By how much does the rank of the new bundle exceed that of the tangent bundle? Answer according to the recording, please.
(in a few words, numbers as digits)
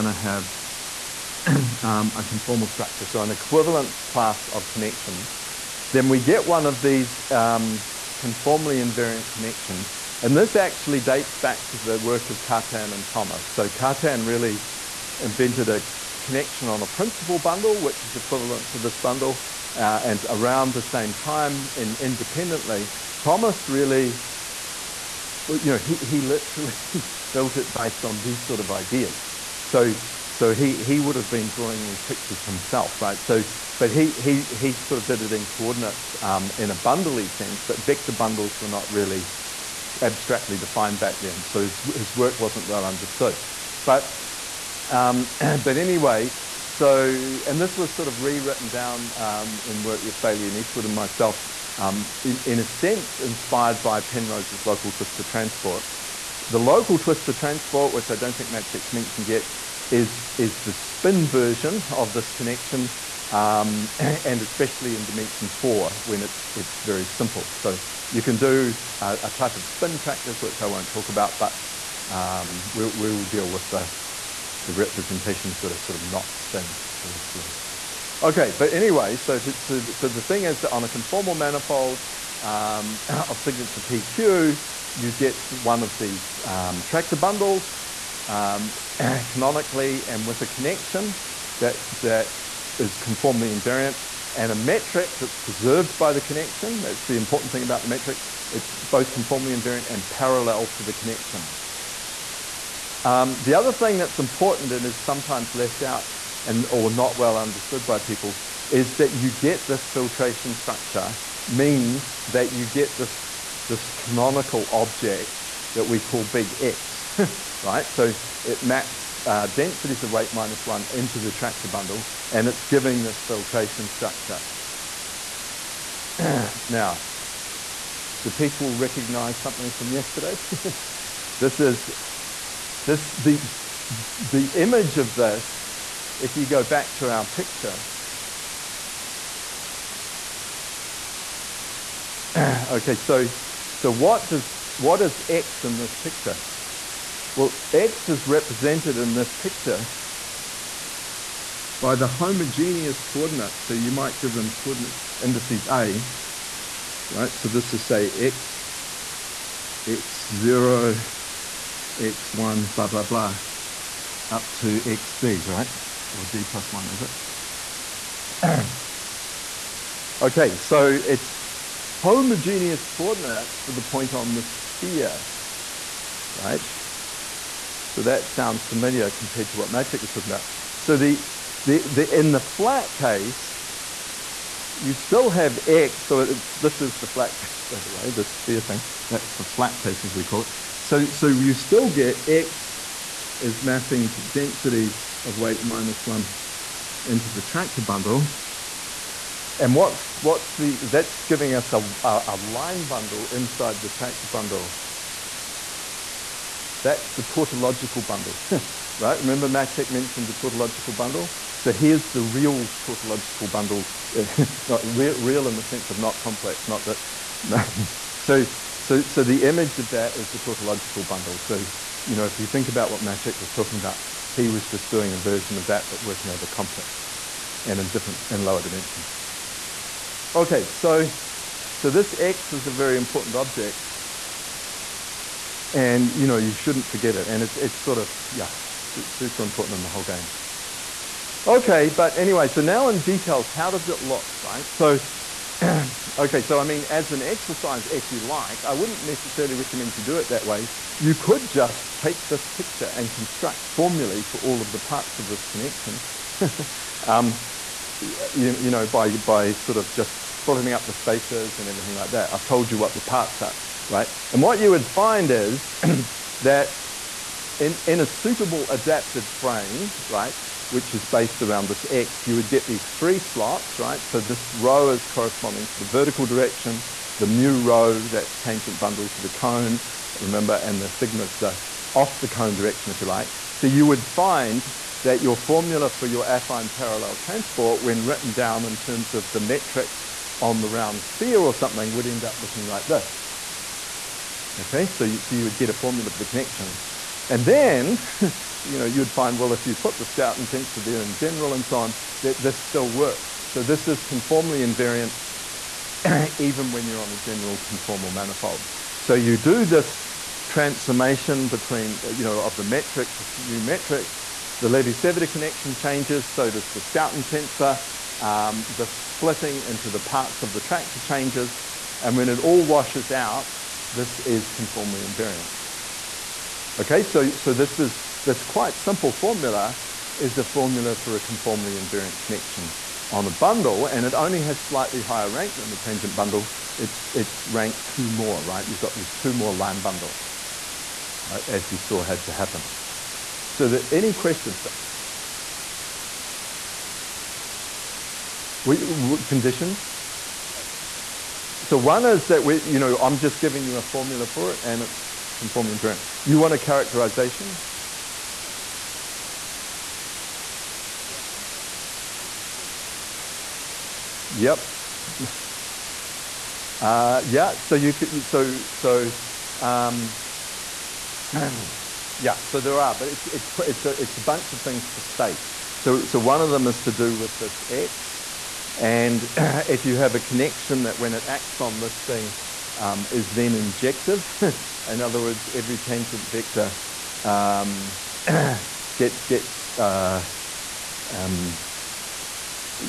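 2.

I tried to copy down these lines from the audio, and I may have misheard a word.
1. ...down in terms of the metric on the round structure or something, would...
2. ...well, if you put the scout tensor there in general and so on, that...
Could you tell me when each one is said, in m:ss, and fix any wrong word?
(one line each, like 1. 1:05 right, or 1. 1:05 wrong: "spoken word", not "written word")
1. 4:48 wrong: "sphere", not "structure"
2. 4:59 right.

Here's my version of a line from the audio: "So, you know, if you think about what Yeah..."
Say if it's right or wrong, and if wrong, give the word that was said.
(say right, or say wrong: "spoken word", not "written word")
wrong: "Maciek", not "Yeah".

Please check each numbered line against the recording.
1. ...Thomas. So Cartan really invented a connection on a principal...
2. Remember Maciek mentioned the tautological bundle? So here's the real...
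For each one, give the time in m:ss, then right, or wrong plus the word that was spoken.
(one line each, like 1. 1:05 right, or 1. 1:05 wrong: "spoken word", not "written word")
1. 0:13 right
2. 3:29 right.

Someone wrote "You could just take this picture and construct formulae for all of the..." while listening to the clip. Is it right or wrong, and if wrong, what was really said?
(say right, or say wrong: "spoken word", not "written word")
right.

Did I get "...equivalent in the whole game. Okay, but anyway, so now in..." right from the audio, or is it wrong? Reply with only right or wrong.
wrong.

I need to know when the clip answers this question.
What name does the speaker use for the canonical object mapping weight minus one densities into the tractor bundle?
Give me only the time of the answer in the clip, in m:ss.
1:56.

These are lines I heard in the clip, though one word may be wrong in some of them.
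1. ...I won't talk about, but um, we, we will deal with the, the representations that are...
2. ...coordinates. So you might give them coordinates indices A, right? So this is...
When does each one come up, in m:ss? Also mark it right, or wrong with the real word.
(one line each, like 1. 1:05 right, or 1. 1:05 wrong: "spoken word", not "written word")
1. 1:10 right
2. 2:33 right.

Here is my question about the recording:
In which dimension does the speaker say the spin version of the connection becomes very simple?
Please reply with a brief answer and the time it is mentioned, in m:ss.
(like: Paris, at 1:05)
4, at 1:05.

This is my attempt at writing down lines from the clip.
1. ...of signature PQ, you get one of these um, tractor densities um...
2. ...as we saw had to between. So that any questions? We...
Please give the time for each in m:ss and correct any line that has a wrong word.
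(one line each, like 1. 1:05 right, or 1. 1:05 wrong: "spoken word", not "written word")
1. 1:23 wrong: "bundles", not "densities"
2. 5:41 wrong: "happen", not "between".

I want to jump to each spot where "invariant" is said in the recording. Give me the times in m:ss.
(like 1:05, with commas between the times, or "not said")
0:08, 1:33, 1:39, 5:04, 5:25, 5:31, 5:55.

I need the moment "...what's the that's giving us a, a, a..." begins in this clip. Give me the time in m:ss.
3:20.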